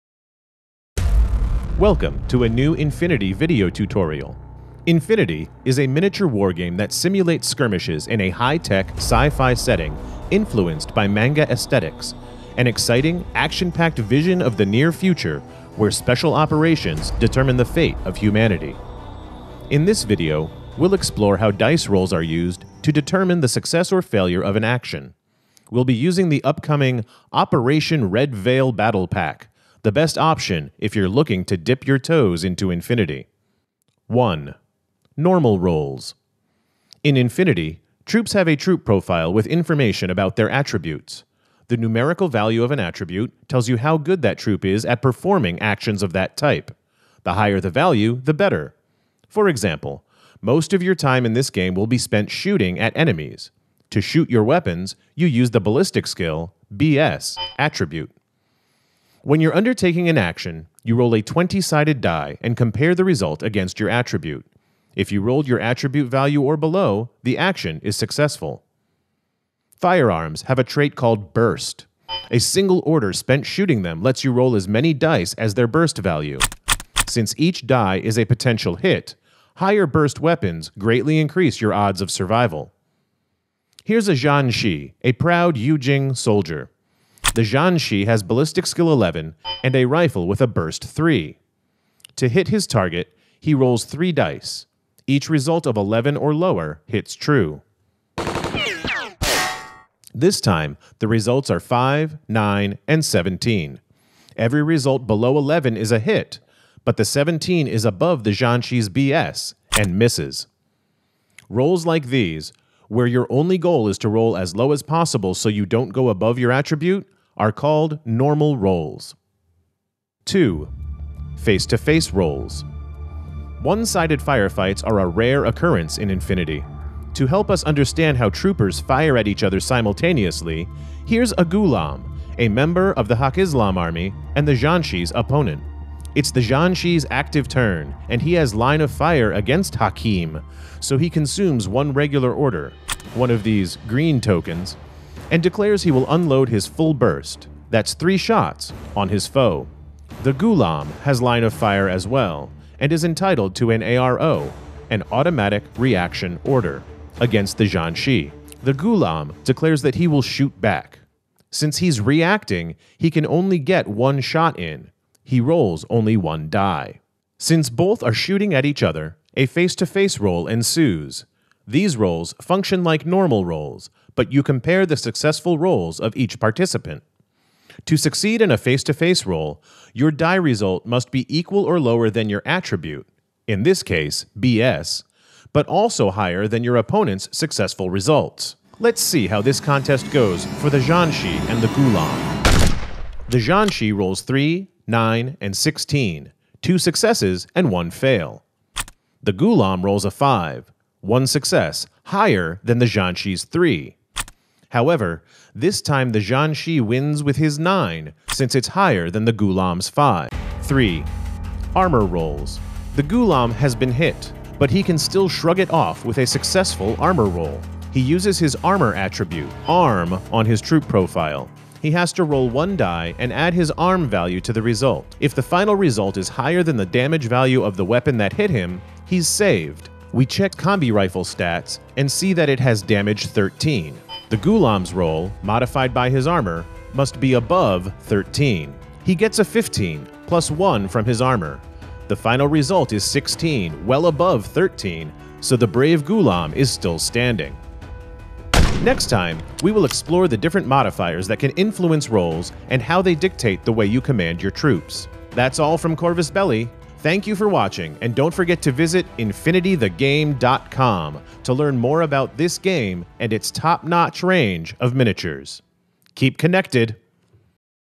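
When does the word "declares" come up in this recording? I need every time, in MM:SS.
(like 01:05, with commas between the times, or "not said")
02:25, 02:39.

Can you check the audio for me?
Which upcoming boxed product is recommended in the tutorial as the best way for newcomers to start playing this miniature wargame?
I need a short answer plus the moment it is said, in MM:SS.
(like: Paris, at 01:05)
Operation Red Veil Battle Pack, at 00:27.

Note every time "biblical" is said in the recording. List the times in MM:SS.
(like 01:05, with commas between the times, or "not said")
not said.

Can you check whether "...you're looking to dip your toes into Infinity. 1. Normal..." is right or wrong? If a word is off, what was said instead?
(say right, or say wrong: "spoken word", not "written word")
right.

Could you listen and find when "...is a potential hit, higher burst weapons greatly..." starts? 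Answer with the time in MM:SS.
01:17.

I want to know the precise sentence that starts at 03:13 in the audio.
The Zhanshi rolls 3, 9, and 16, two successes and one fail.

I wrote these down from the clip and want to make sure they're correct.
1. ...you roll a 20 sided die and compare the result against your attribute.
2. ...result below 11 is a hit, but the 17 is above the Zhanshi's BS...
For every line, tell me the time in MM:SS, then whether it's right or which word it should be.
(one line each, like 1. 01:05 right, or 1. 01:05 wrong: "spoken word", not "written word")
1. 01:00 right
2. 01:44 right.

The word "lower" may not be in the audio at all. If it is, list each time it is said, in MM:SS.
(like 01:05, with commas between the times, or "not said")
01:36, 03:01.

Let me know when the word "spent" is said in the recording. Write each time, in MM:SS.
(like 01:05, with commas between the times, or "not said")
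00:51, 01:13.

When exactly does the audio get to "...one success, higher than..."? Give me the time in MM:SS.
03:20.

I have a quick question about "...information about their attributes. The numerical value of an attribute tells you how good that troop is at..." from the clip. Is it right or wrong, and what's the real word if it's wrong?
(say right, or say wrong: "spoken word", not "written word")
right.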